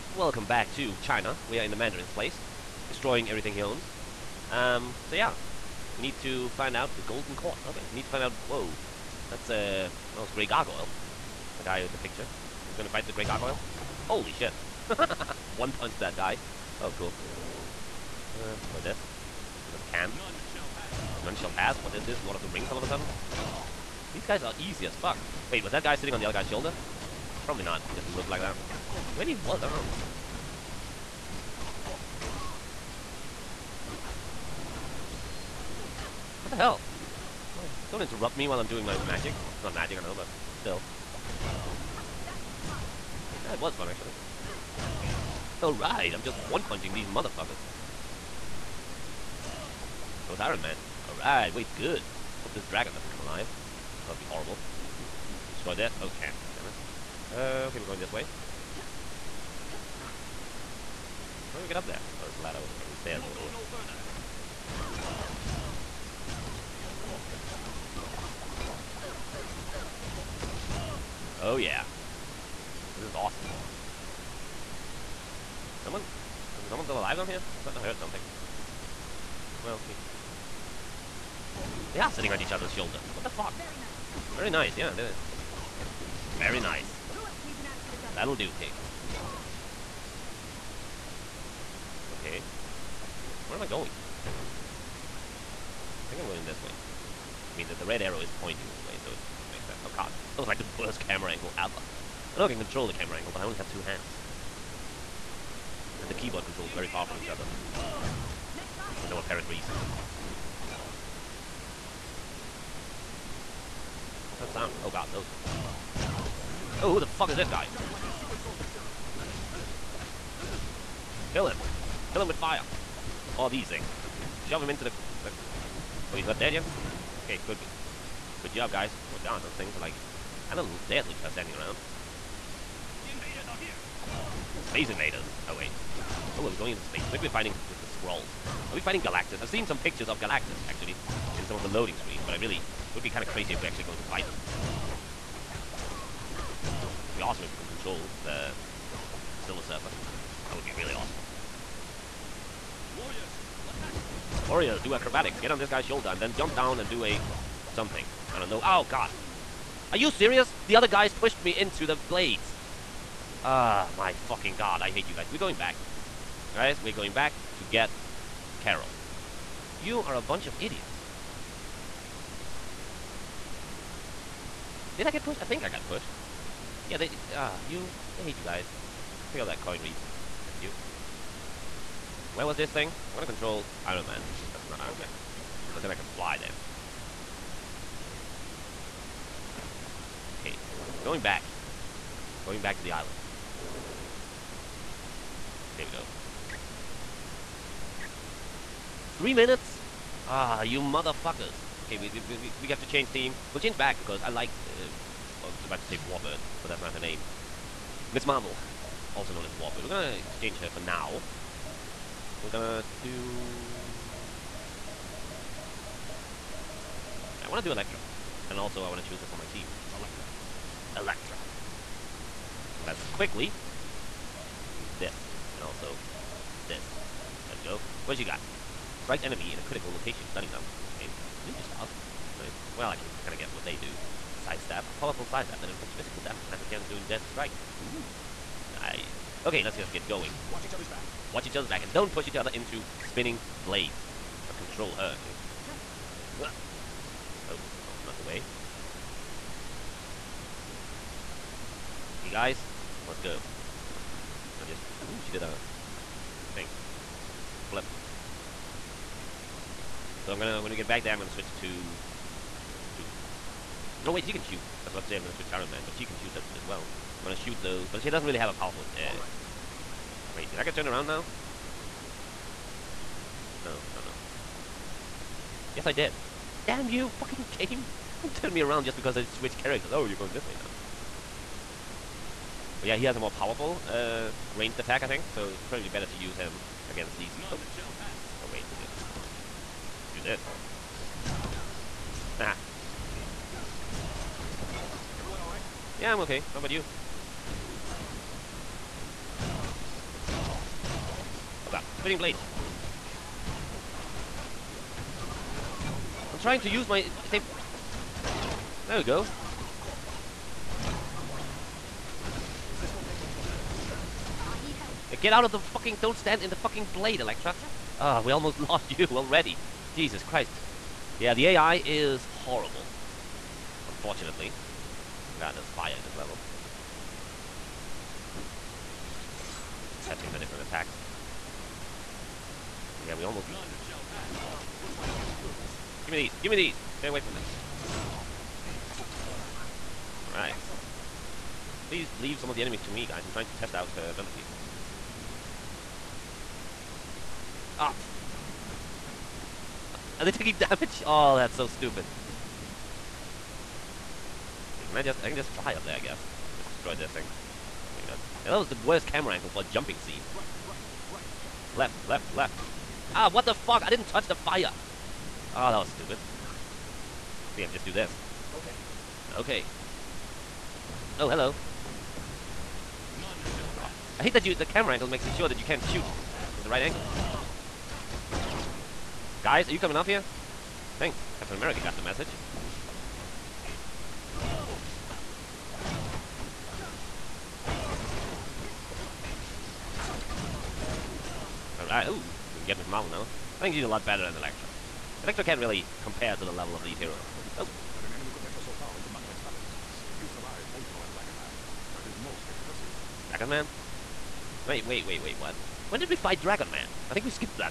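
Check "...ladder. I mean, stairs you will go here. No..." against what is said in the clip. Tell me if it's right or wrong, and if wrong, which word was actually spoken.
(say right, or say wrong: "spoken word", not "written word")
right.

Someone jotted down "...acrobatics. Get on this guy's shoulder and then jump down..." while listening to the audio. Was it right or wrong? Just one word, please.
right.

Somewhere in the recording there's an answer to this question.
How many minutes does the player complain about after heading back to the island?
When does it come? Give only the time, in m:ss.
3:19.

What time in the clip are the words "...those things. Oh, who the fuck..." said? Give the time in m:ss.
1:55.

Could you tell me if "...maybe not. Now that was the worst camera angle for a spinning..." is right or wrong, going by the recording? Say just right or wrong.
wrong.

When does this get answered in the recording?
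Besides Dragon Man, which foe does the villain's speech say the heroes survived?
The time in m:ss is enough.
6:40.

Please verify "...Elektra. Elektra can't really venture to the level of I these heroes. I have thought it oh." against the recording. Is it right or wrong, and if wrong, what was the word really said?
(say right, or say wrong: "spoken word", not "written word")
wrong: "compare", not "venture".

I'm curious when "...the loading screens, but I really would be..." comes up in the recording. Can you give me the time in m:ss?
2:21.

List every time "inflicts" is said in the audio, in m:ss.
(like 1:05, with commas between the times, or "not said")
3:55.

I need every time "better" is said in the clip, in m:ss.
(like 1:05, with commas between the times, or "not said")
4:45, 6:34.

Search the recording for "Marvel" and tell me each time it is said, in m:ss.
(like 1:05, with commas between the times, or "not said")
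3:28, 6:32.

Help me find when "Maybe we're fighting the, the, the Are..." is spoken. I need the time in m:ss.
2:17.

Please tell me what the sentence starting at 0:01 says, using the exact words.
We are in the Mandarin's place, destroying everything he owns.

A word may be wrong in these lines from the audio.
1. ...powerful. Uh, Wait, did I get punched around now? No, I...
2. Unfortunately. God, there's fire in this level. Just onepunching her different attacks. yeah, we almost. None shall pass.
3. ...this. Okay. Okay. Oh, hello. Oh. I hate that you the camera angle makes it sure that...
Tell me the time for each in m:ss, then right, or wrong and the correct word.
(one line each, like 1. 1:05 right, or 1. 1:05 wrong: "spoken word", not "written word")
1. 4:28 wrong: "turned", not "punched"
2. 5:23 wrong: "testing", not "onepunching"
3. 6:07 right.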